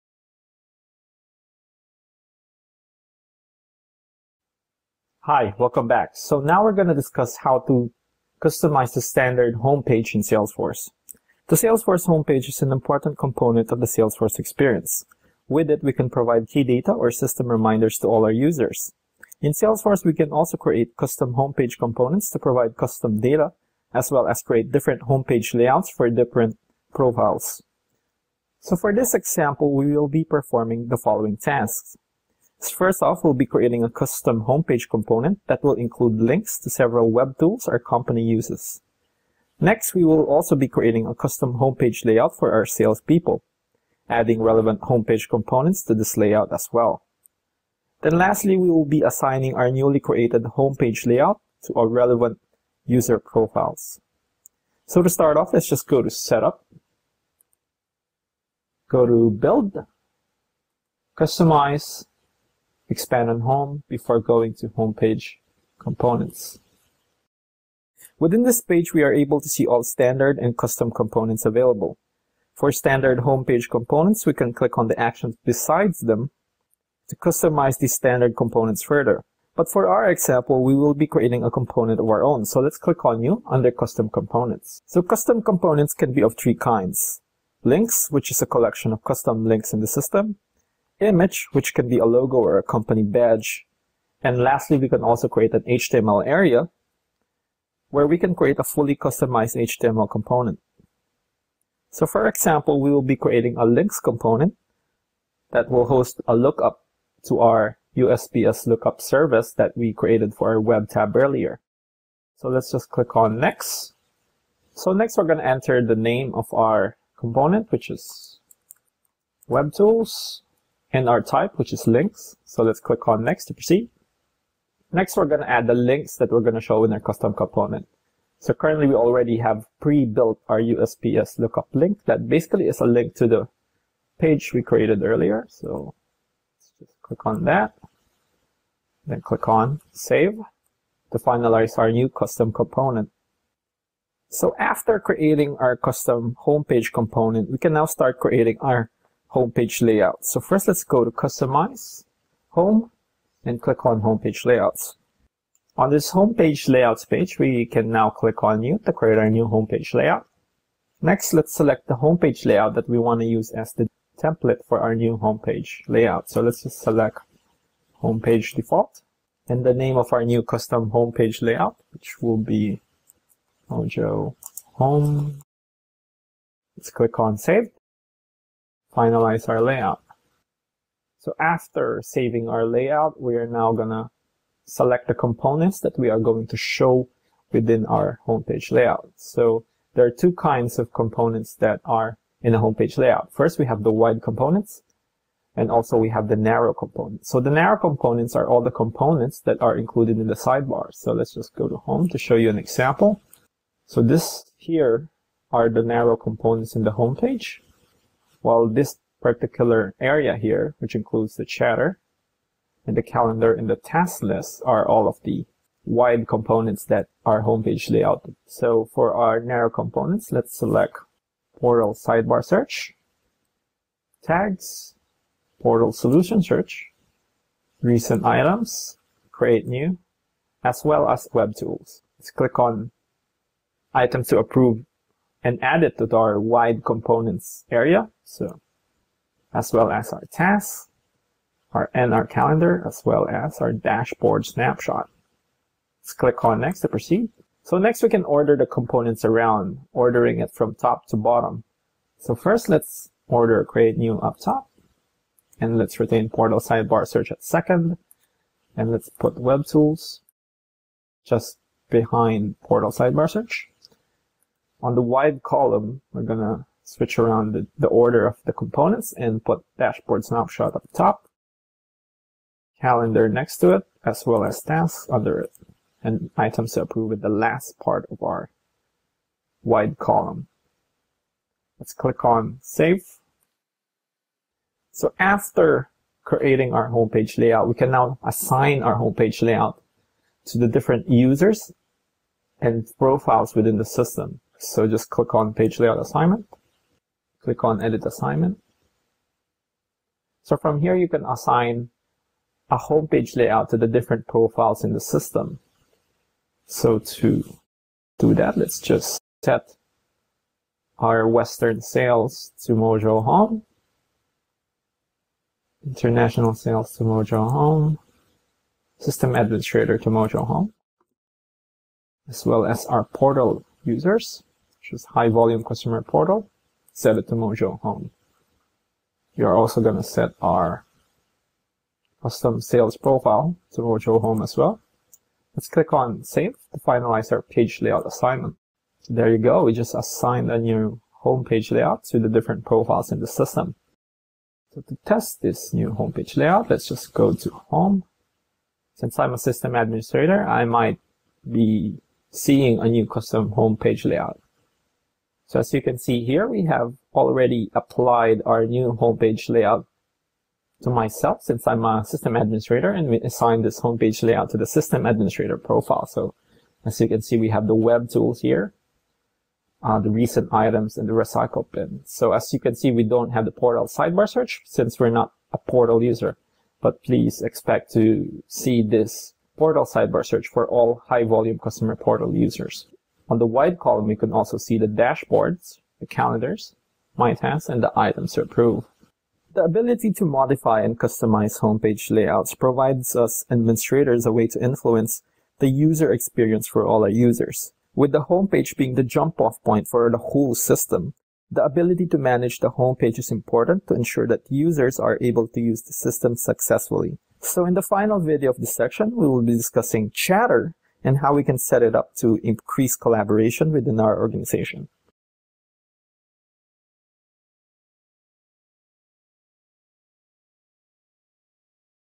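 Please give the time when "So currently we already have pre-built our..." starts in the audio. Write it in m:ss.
2:08.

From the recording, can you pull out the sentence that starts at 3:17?
So the narrow components are all the components that are included in the sidebar.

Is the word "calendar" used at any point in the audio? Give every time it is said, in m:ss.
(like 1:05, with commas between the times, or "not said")
3:33, 4:02, 4:32, 6:26.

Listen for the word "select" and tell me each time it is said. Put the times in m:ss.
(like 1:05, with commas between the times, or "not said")
2:41, 2:46, 3:04, 3:40.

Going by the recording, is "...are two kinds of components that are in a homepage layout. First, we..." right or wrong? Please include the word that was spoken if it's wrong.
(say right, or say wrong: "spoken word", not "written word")
right.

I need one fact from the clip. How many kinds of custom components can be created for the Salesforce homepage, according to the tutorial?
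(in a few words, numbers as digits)
3.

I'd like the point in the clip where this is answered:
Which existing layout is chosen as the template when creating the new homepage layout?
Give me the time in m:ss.
2:48.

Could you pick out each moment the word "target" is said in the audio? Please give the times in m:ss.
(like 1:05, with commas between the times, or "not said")
not said.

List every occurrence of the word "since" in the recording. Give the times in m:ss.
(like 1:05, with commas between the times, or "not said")
5:48, 6:01, 6:14.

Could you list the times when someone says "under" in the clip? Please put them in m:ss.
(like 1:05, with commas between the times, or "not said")
1:23, 4:35.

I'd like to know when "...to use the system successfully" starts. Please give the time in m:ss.
6:45.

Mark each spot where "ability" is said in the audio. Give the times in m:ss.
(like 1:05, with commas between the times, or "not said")
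6:29, 6:41.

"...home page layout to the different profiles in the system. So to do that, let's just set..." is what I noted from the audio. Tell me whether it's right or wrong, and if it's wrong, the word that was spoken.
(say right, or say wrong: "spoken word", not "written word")
right.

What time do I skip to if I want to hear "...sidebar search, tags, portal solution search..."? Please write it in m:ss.
3:41.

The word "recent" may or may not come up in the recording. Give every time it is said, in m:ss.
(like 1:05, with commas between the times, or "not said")
3:47, 6:10.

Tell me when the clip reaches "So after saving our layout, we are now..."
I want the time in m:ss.
3:01.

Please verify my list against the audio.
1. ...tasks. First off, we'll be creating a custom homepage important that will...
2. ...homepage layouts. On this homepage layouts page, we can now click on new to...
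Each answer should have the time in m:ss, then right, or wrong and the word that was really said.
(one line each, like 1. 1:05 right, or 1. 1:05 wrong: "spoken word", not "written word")
1. 0:31 wrong: "component", not "important"
2. 2:34 right.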